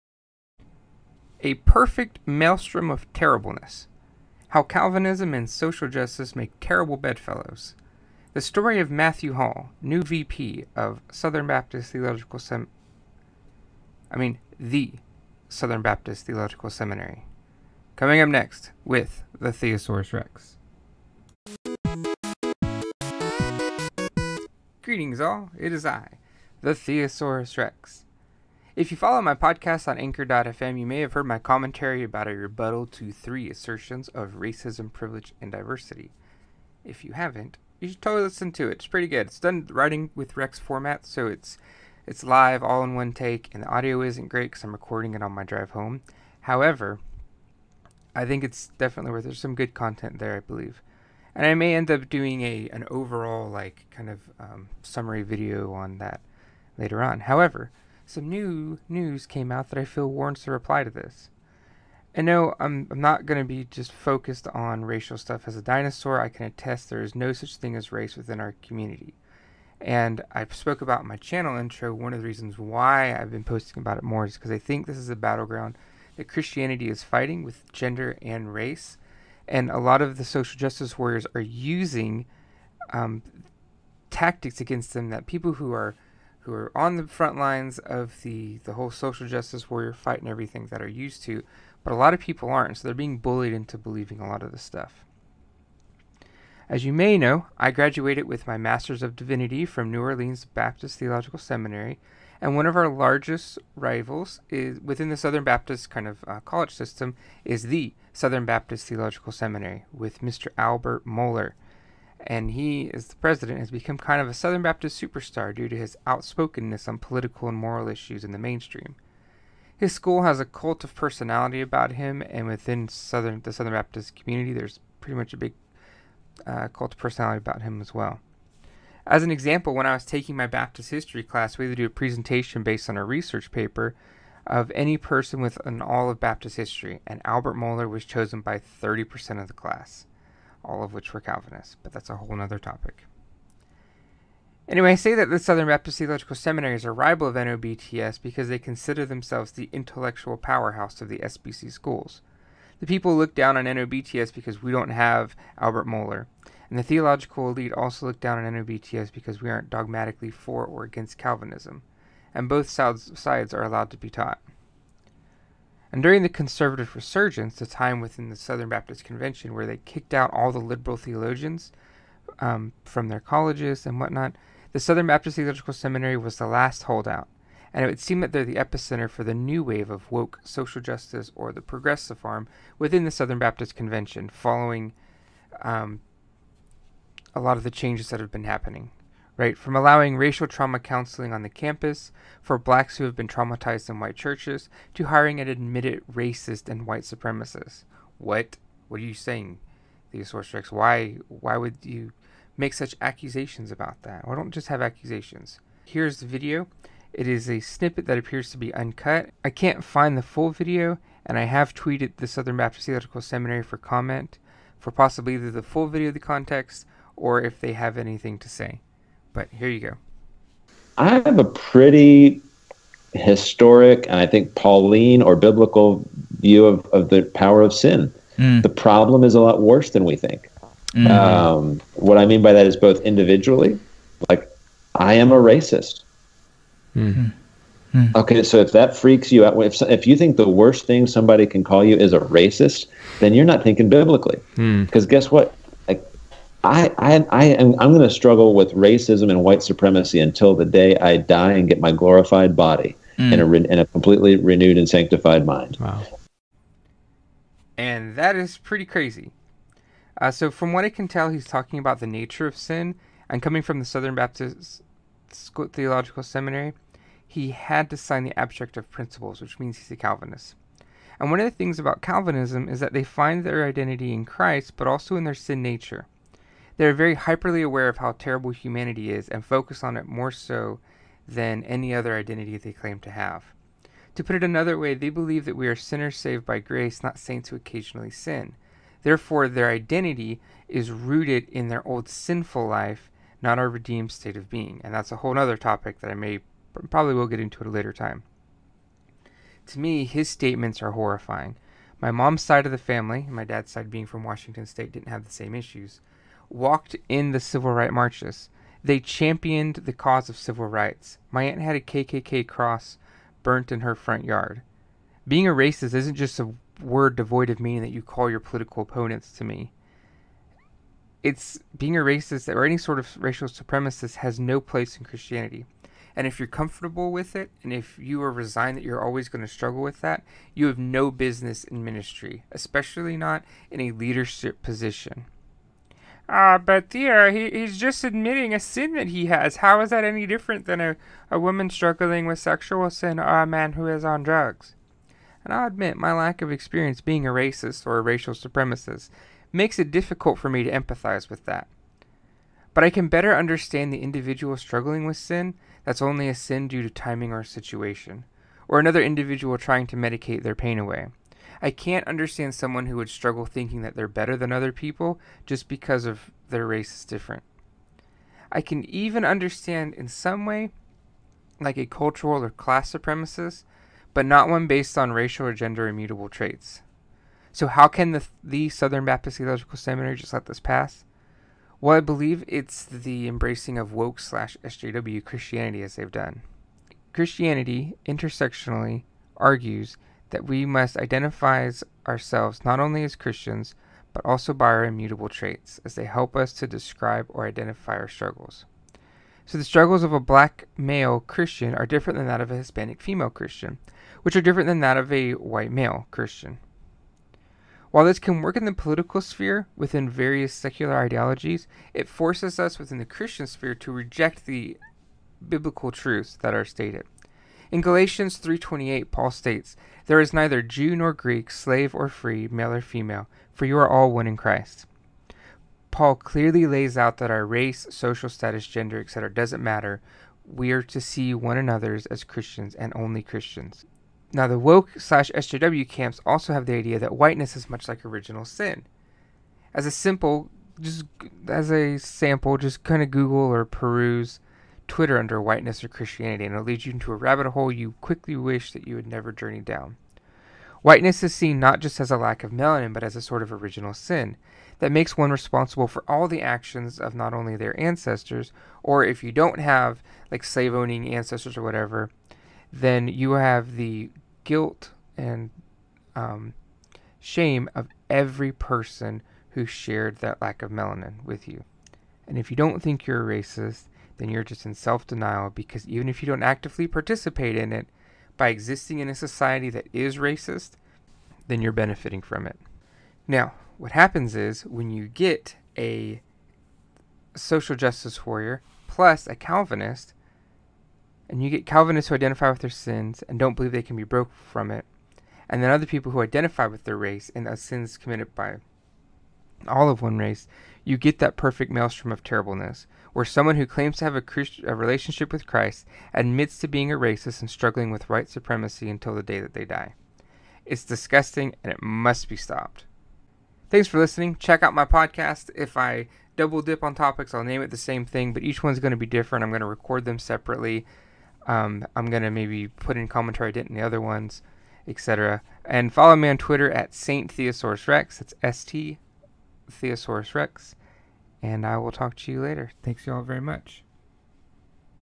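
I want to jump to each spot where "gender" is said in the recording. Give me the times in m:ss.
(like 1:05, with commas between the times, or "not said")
1:17, 6:15, 7:08.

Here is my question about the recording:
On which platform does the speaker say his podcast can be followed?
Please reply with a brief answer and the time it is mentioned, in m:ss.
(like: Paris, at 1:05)
anchor.fm, at 0:29.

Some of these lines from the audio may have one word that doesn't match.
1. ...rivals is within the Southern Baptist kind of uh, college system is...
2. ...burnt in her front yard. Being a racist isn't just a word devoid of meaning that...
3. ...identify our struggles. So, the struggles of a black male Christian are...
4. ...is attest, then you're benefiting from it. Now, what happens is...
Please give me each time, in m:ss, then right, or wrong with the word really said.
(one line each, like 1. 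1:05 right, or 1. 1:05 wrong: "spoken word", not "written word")
1. 1:43 right
2. 5:13 right
3. 6:37 right
4. 7:59 wrong: "racist", not "attest".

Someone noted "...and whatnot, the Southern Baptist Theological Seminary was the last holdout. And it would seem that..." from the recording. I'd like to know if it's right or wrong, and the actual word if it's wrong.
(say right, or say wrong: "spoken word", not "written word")
right.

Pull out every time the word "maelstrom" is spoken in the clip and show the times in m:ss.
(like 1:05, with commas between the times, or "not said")
0:02, 8:21.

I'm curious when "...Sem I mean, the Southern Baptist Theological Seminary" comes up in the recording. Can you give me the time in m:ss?
0:12.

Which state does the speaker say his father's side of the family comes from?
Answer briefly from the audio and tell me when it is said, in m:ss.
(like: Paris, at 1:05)
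Washington State, at 5:04.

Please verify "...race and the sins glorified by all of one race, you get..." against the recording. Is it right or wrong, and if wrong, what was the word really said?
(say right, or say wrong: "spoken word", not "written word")
wrong: "committed", not "glorified".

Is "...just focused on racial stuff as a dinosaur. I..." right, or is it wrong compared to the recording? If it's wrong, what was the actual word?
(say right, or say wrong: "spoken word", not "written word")
right.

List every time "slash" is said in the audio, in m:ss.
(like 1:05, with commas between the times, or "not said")
6:24, 7:14.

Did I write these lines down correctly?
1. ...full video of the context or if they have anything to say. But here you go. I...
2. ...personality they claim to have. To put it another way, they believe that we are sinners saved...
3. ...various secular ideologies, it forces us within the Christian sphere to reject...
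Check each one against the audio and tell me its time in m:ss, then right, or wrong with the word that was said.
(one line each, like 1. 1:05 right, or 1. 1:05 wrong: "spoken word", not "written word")
1. 3:35 right
2. 4:42 wrong: "identity", not "personality"
3. 6:50 right.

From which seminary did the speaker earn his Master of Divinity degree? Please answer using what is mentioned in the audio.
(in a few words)
New Orleans Baptist Theological Seminary.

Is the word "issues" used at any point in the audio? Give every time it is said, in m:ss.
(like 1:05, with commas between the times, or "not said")
1:57, 5:05.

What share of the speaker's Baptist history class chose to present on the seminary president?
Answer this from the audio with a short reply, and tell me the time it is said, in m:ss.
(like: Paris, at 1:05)
30%, at 2:18.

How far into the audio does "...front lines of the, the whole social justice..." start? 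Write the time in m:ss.
1:27.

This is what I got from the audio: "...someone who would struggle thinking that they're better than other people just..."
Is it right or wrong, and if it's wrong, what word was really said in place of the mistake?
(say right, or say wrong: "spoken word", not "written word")
right.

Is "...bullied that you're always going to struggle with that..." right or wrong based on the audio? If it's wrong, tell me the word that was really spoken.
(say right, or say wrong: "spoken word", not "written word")
wrong: "resigned", not "bullied".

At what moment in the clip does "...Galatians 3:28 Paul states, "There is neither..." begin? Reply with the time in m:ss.
6:57.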